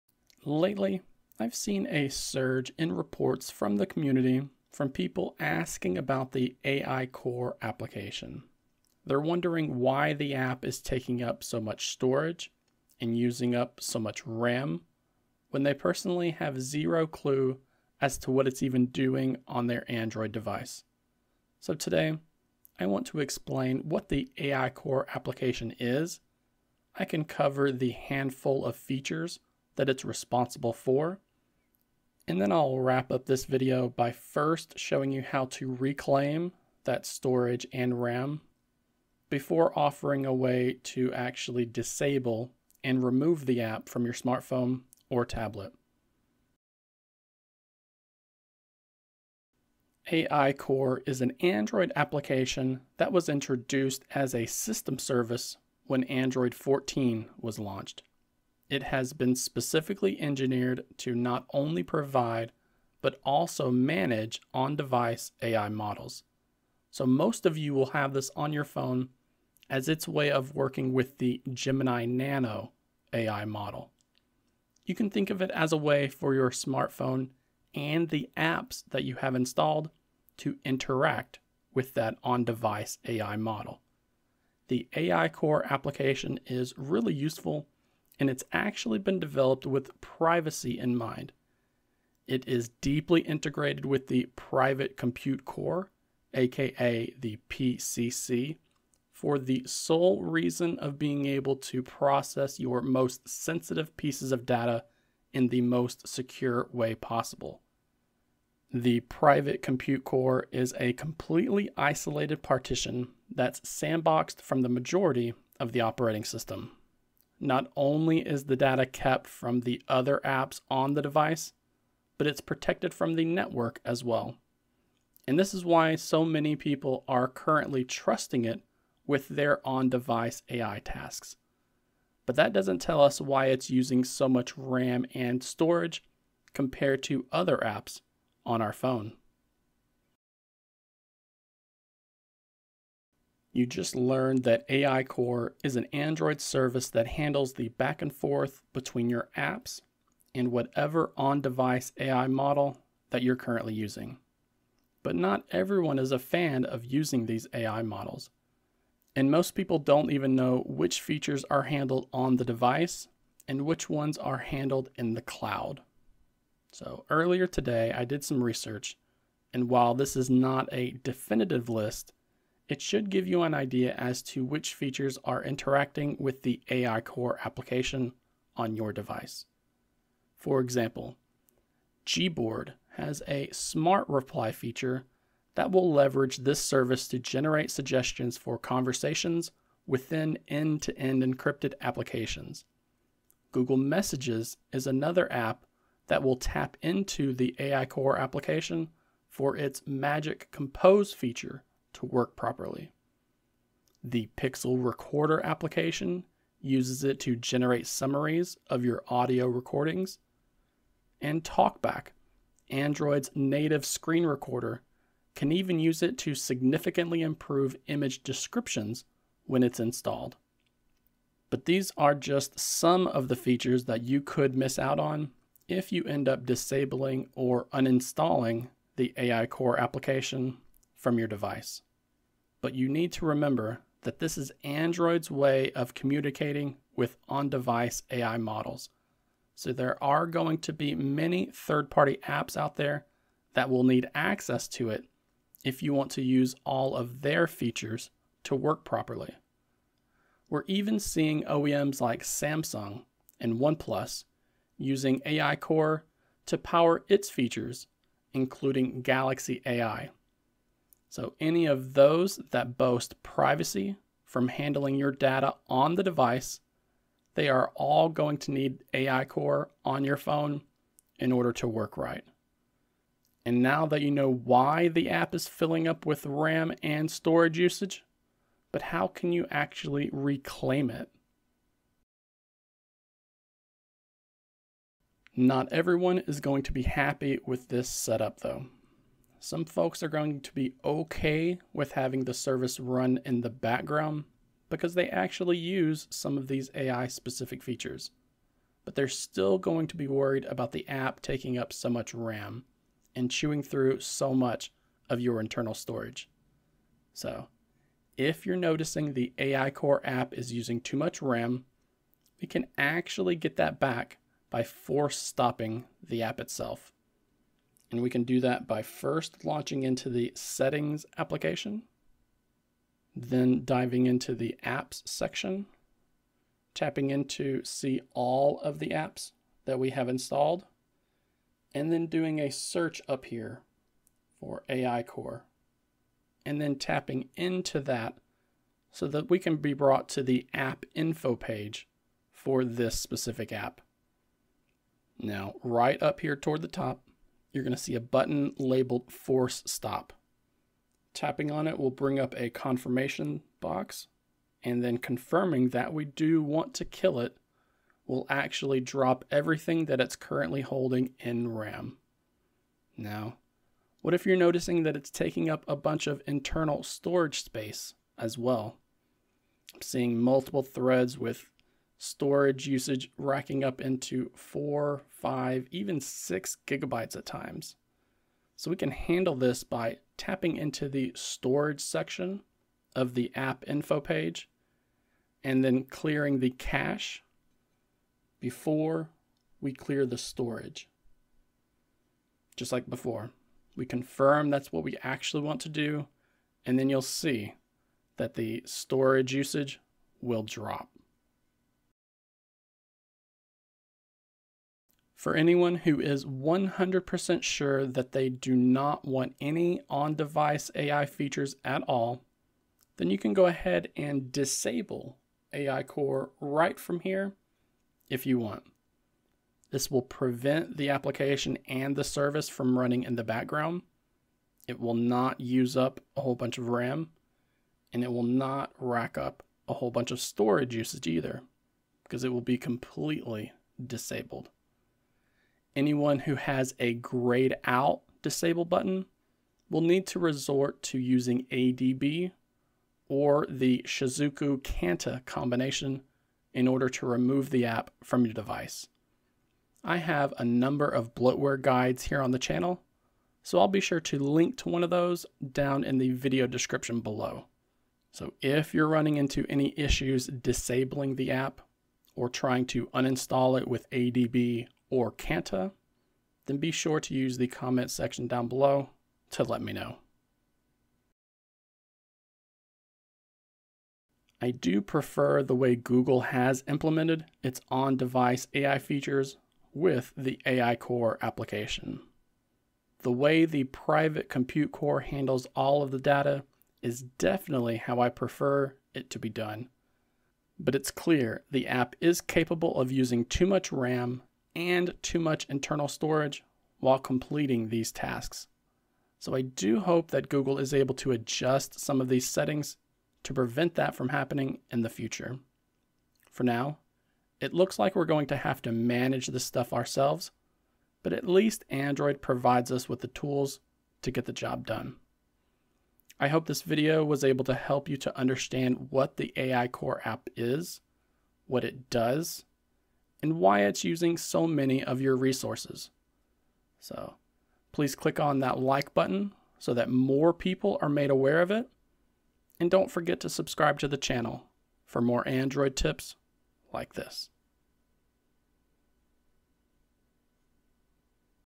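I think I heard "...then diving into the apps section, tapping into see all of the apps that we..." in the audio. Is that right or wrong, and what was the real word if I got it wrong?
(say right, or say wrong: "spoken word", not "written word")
right.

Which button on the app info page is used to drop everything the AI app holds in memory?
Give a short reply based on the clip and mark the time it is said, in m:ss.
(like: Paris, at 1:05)
Force stop, at 5:49.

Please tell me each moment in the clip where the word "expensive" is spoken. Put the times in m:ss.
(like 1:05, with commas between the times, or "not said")
not said.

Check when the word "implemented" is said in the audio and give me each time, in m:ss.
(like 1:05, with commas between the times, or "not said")
7:56.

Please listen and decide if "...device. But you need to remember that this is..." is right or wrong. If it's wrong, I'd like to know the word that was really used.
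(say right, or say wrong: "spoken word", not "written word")
right.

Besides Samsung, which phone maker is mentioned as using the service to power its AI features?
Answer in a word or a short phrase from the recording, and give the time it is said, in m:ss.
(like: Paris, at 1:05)
OnePlus, at 4:13.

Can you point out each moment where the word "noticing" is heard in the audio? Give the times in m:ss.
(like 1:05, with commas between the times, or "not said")
5:08, 6:04.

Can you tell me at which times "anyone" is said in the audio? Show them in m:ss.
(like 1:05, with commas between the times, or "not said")
6:45, 7:15.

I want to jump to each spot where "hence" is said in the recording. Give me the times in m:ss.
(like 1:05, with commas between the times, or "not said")
not said.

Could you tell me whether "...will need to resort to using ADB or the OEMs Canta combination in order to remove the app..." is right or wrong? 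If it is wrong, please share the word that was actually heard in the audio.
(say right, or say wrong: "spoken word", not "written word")
wrong: "Shizuku", not "OEMs".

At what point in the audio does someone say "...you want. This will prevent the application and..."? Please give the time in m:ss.
6:58.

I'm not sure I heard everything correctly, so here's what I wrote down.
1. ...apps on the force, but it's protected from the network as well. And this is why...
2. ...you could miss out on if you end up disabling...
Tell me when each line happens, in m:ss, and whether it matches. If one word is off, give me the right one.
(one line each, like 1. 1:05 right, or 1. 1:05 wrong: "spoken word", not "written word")
1. 2:00 wrong: "device", not "force"
2. 3:44 right.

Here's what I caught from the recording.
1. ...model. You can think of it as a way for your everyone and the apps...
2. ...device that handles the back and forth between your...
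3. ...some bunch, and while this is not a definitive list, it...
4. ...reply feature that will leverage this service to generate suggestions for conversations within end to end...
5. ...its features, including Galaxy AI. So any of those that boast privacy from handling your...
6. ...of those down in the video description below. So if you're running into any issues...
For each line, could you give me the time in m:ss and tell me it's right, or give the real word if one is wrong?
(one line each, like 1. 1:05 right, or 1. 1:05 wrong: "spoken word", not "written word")
1. 1:13 wrong: "smartphone", not "everyone"
2. 2:26 wrong: "service", not "device"
3. 2:48 wrong: "research", not "bunch"
4. 3:04 right
5. 4:17 right
6. 7:34 right.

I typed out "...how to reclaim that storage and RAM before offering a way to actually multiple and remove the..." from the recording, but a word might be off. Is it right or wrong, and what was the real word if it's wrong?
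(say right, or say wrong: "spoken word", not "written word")
wrong: "disable", not "multiple".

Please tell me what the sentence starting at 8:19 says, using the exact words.
So I do hope that Google is able to adjust some of these settings to prevent that from happening in the future.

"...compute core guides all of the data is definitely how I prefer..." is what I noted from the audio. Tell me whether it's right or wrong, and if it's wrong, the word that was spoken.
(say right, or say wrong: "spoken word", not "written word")
wrong: "handles", not "guides".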